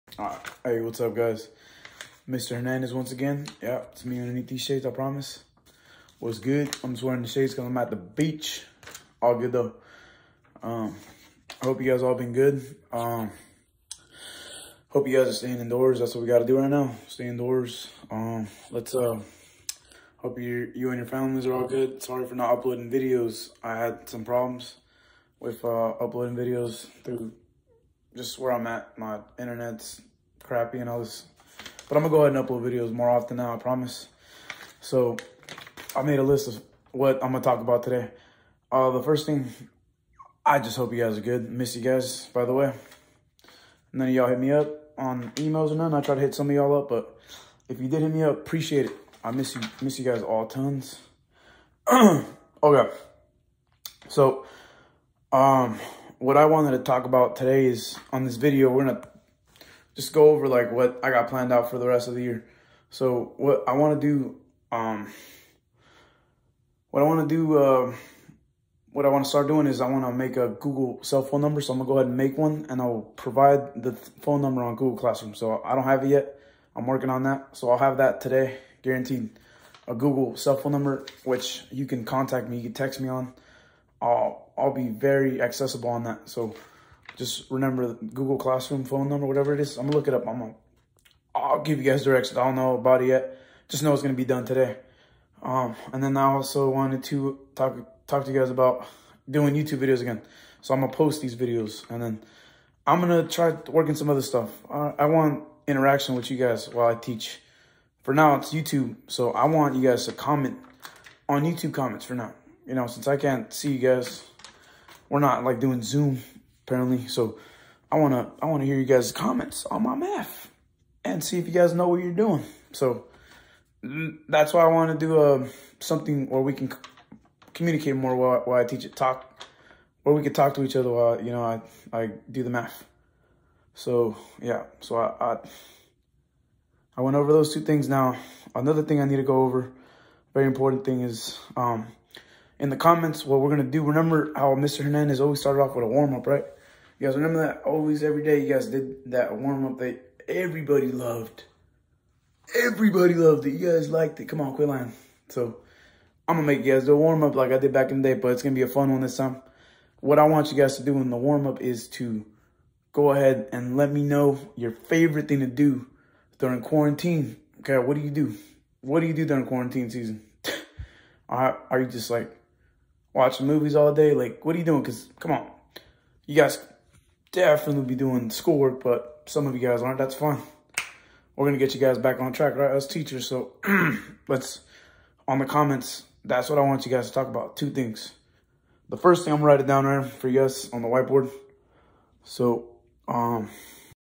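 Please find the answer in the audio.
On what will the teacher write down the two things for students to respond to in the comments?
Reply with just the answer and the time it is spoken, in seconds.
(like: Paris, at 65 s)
the whiteboard, at 190 s.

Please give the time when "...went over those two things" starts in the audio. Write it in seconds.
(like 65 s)
137 s.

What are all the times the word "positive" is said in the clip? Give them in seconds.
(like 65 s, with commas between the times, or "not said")
not said.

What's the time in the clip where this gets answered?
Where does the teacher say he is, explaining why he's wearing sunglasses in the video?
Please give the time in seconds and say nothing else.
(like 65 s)
7 s.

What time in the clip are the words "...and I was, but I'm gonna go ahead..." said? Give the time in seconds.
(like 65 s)
30 s.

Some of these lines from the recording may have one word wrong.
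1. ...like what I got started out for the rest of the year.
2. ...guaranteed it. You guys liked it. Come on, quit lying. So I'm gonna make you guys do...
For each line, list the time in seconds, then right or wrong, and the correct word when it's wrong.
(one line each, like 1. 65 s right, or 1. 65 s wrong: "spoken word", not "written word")
1. 60 s wrong: "planned", not "started"
2. 153 s wrong: "loved", not "guaranteed".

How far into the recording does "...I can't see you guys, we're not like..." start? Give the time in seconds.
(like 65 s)
113 s.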